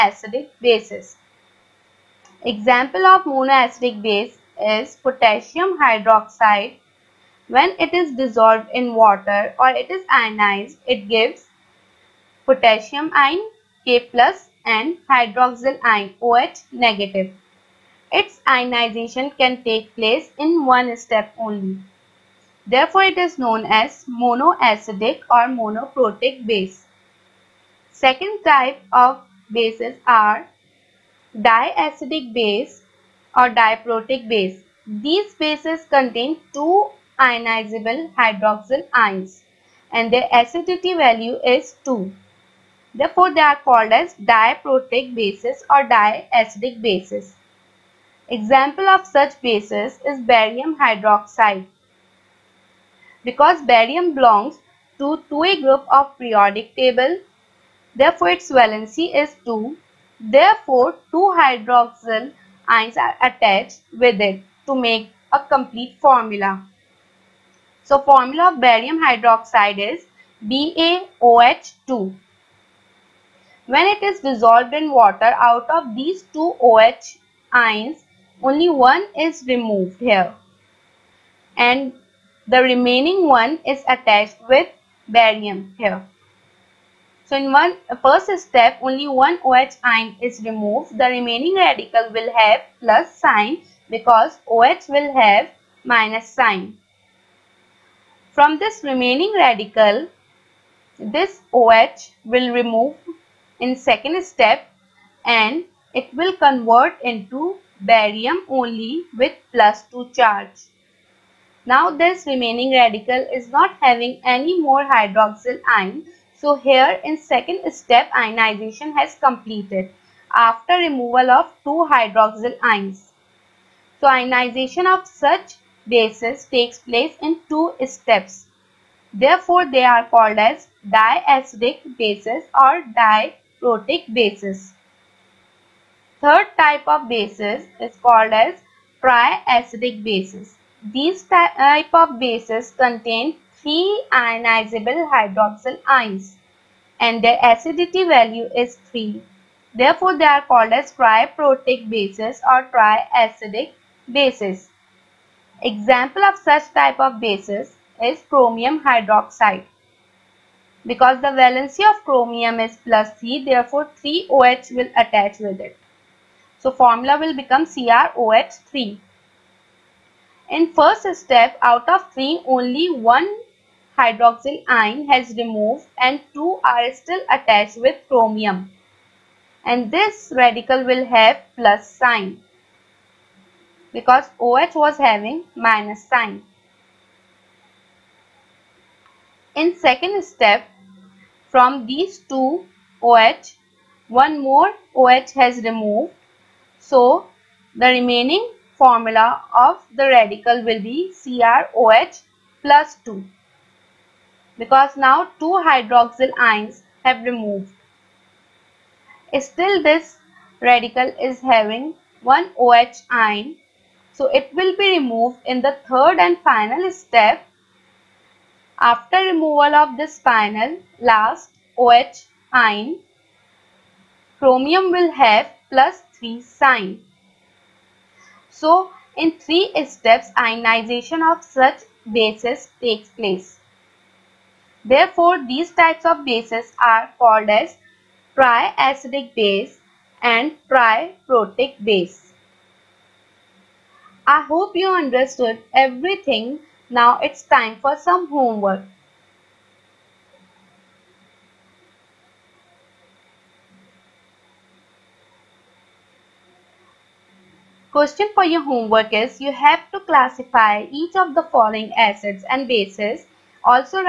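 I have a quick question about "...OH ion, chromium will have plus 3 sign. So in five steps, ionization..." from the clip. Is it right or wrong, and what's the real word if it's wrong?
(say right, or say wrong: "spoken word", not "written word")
wrong: "three", not "five".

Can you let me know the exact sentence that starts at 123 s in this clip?
So ionization of such bases takes place in two steps.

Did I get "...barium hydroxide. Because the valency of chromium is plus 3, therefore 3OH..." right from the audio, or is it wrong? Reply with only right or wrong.
wrong.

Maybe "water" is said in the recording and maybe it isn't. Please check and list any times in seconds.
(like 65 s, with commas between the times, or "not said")
8 s, 74 s.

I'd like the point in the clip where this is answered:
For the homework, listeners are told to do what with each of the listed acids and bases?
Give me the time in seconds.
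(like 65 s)
260 s.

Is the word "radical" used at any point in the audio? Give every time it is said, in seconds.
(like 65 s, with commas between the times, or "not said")
91 s, 99 s, 112 s, 180 s, 200 s, 210 s.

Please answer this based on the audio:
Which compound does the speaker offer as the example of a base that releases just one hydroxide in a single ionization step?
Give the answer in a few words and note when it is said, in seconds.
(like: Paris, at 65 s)
Potassium hydroxide, at 4 s.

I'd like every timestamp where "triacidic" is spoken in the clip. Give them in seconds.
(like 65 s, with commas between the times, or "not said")
139 s, 152 s, 238 s.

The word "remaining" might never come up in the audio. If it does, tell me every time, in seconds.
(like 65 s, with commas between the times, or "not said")
82 s, 91 s, 98 s, 112 s, 197 s.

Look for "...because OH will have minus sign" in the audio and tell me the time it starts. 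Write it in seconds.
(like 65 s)
93 s.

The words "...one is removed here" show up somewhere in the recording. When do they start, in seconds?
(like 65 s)
78 s.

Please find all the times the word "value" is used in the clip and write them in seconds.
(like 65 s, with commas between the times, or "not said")
40 s, 148 s.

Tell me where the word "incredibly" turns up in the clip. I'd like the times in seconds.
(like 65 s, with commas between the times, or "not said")
not said.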